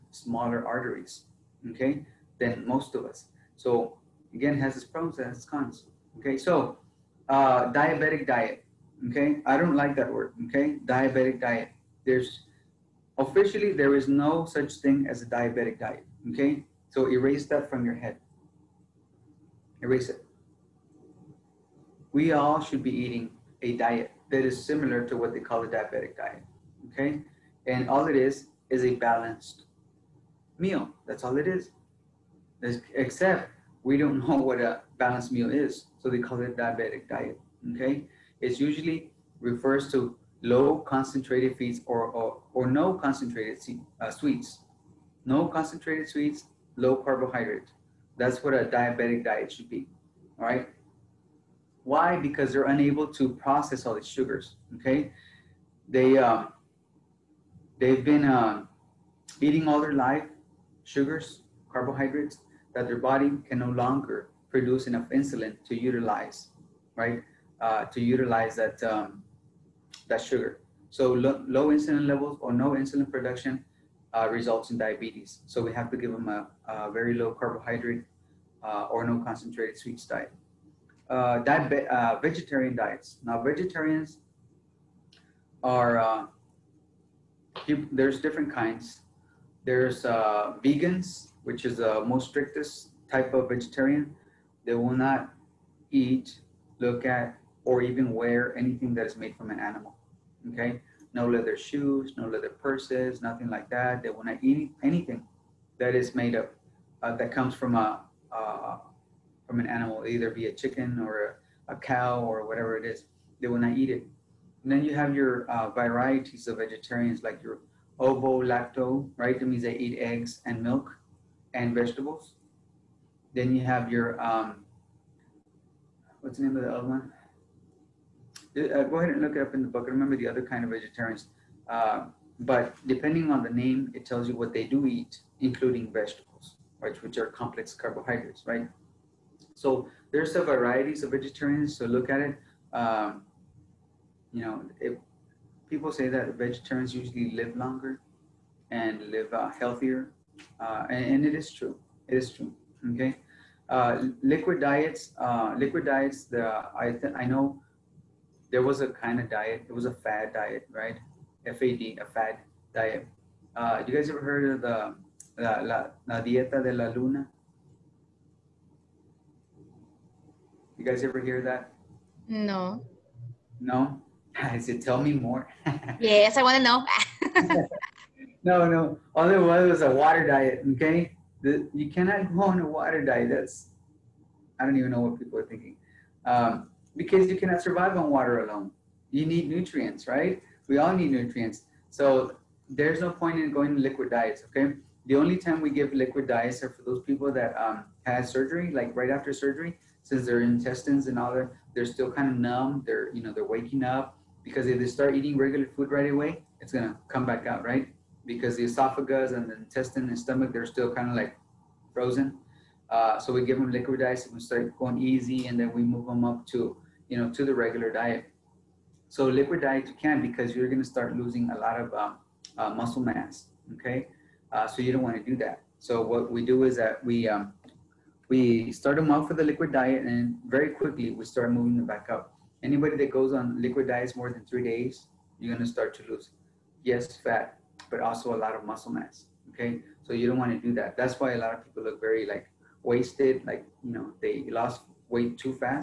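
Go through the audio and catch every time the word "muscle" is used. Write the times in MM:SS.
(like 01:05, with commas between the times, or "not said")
03:42, 03:58.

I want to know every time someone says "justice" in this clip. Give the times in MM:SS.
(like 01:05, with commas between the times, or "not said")
not said.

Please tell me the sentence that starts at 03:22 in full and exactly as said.
They're, you know, they're waking up because if they start eating regular food right away, it's gonna come back out, right?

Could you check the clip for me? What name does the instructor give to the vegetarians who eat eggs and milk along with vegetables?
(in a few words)
Ovo lacto.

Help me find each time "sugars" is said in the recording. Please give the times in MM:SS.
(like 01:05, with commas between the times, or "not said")
00:54, 01:00, 01:10.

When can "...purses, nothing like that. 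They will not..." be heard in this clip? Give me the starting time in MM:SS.
01:42.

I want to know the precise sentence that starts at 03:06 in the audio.
Um, because you cannot survive on water alone.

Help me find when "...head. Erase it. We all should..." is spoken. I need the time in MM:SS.
00:17.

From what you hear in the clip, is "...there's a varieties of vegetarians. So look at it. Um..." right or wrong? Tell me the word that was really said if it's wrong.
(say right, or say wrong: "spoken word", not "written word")
right.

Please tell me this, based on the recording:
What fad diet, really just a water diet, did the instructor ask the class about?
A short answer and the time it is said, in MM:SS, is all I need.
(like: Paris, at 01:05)
La dieta de la luna, at 02:46.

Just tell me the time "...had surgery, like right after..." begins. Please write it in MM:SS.
03:18.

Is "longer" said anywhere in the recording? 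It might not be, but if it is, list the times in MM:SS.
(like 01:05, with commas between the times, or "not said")
01:03, 02:27.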